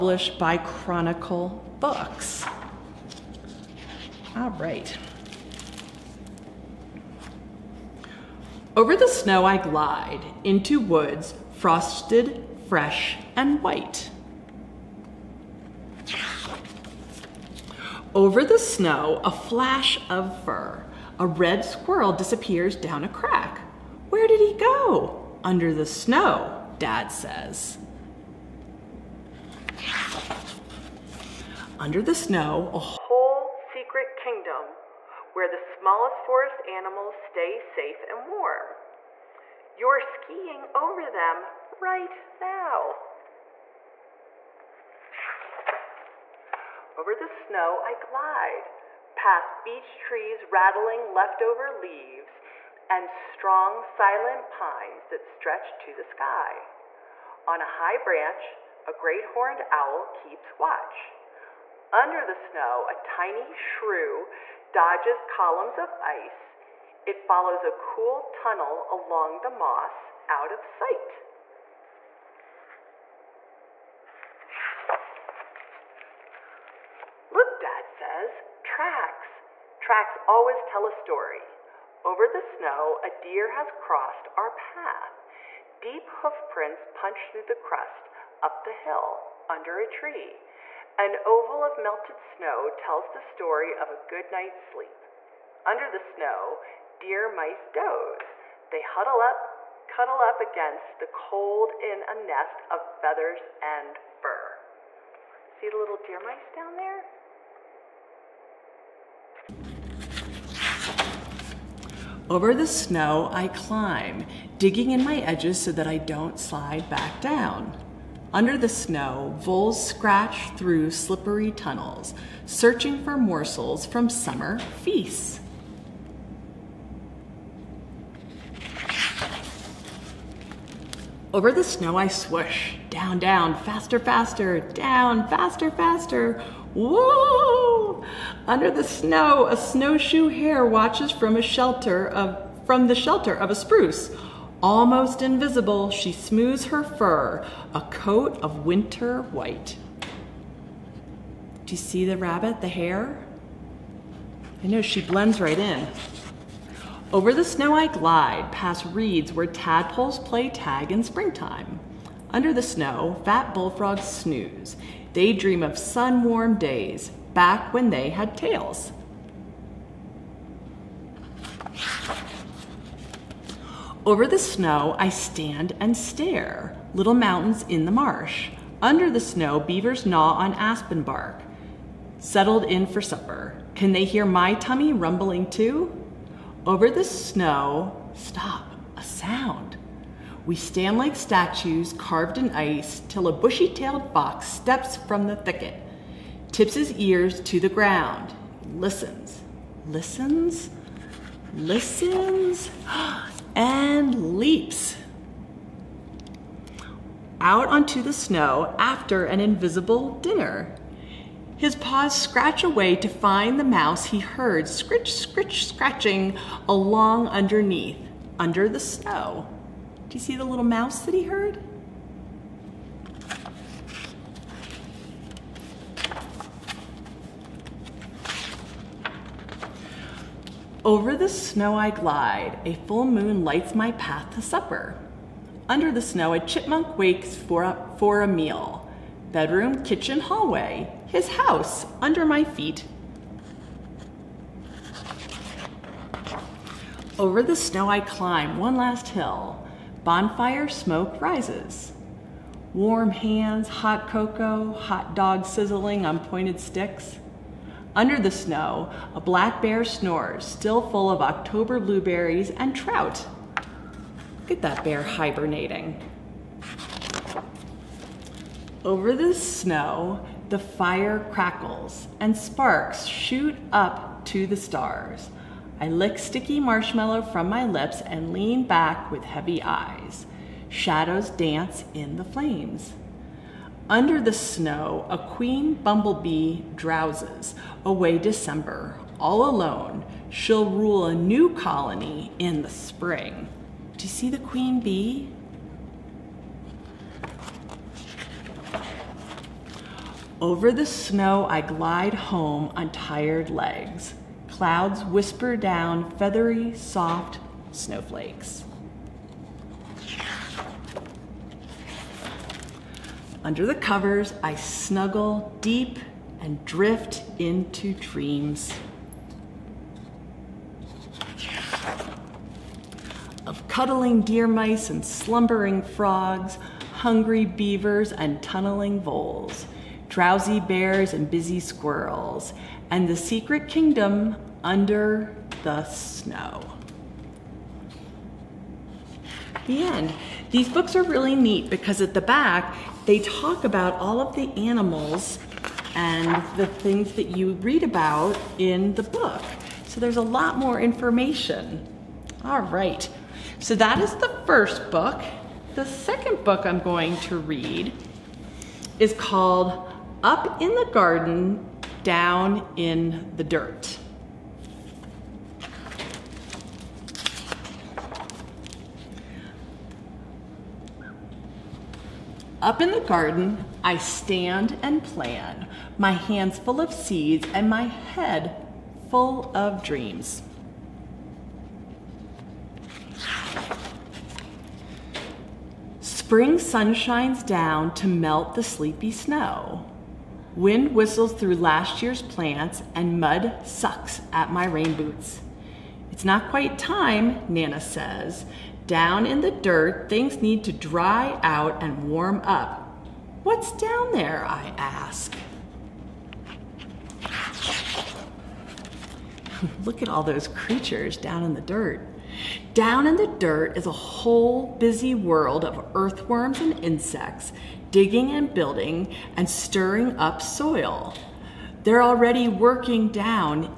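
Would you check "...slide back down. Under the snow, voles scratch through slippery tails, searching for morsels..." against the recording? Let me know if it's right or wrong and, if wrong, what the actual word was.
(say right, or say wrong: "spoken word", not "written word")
wrong: "tunnels", not "tails".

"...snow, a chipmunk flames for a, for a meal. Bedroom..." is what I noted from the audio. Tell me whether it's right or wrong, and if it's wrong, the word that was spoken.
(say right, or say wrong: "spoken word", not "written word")
wrong: "wakes", not "flames".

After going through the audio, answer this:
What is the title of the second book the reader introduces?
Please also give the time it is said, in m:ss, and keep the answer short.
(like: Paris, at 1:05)
Up in the Garden, Down in the Dirt, at 6:00.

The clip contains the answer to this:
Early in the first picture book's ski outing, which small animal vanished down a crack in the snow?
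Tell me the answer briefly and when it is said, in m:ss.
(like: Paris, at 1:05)
A red squirrel, at 0:21.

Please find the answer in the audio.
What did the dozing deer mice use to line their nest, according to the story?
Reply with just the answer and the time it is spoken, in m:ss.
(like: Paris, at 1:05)
Feathers and fur, at 1:43.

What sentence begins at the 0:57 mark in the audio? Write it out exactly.
On a high branch, a great horned owl keeps watch.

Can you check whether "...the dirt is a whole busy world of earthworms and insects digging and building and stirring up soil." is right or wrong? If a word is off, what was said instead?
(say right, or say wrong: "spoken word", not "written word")
right.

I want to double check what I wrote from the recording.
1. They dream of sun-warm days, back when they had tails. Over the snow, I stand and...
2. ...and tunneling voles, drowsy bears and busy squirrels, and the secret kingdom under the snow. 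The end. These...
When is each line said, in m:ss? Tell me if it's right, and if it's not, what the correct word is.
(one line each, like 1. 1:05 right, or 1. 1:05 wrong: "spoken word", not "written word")
1. 2:45 right
2. 5:28 right.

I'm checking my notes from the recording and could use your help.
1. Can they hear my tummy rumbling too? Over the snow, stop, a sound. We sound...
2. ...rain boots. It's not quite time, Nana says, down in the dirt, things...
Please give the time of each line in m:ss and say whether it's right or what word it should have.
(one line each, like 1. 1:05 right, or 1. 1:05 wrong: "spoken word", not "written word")
1. 3:03 wrong: "stand", not "sound"
2. 6:34 right.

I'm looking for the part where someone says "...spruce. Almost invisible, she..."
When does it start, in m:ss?
2:23.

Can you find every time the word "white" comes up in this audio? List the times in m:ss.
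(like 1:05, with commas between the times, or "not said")
0:13, 2:29.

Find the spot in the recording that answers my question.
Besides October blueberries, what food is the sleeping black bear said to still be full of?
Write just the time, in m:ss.
4:22.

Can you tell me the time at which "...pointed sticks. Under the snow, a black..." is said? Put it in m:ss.
4:16.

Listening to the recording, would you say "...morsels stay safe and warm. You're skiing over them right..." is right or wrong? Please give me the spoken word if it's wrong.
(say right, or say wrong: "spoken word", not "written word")
wrong: "animals", not "morsels".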